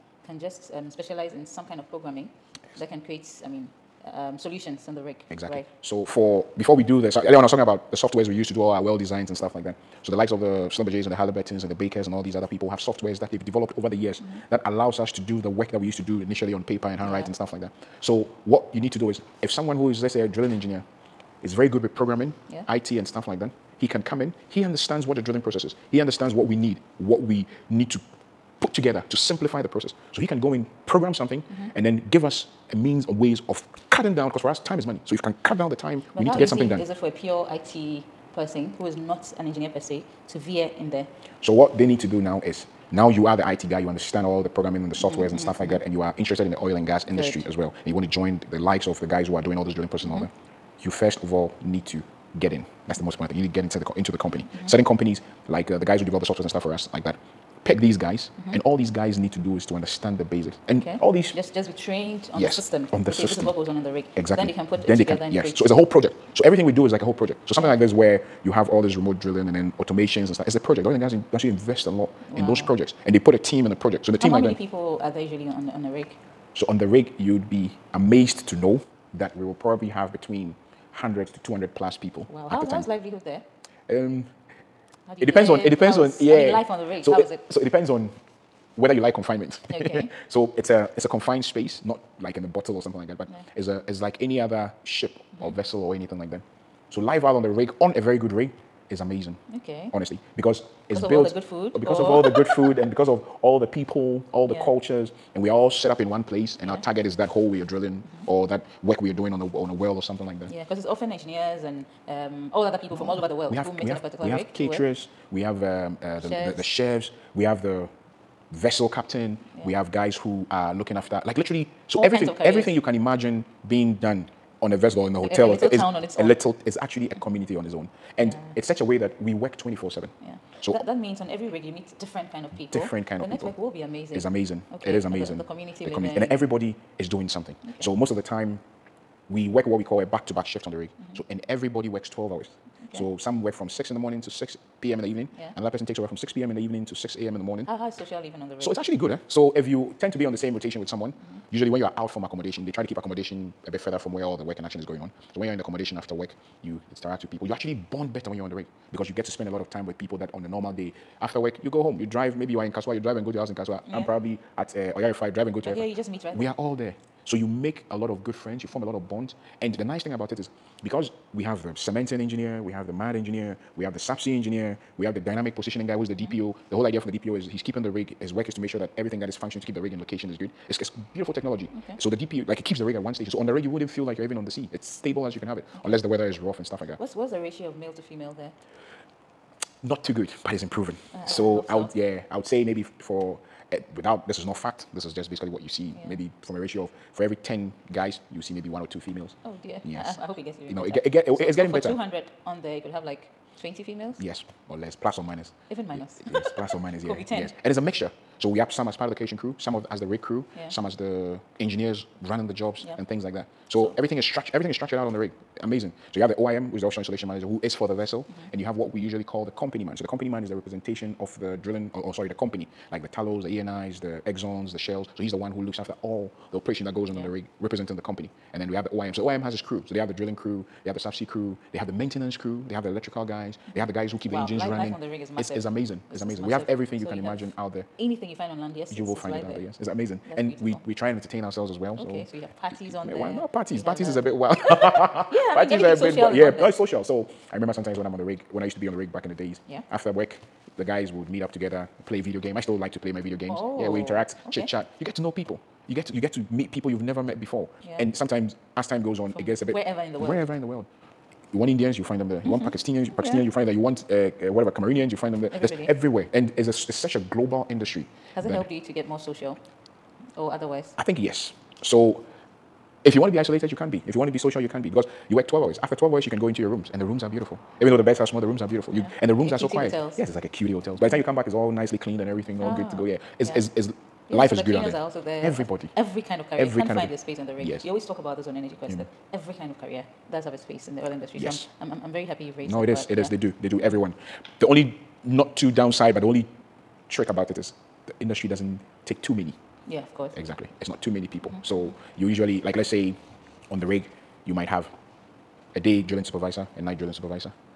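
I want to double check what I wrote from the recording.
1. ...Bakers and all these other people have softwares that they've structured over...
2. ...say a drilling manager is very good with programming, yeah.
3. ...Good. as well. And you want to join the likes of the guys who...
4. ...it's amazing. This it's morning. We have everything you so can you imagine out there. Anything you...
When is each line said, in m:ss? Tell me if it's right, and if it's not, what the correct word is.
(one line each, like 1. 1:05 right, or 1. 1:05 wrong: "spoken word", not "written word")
1. 0:11 wrong: "developed", not "structured"
2. 0:20 wrong: "engineer", not "manager"
3. 0:47 right
4. 3:55 wrong: "amazing", not "morning".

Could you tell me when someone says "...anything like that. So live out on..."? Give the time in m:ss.
1:35.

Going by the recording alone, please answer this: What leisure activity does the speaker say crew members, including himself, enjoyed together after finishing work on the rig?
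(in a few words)
Video games.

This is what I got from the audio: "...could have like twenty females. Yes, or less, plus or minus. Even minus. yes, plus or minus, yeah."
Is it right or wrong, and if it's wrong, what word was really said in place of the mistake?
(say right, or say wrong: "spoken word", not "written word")
right.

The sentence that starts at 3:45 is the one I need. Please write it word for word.
So he's the one who looks after all the operation that goes on yeah.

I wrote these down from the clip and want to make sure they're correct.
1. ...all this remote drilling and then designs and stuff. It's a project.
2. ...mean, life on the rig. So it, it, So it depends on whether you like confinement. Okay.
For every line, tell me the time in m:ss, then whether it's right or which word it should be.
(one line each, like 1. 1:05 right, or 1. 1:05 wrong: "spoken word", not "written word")
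1. 1:08 wrong: "automations", not "designs"
2. 1:26 right.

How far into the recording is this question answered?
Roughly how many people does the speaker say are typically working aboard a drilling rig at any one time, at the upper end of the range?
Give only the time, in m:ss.
1:20.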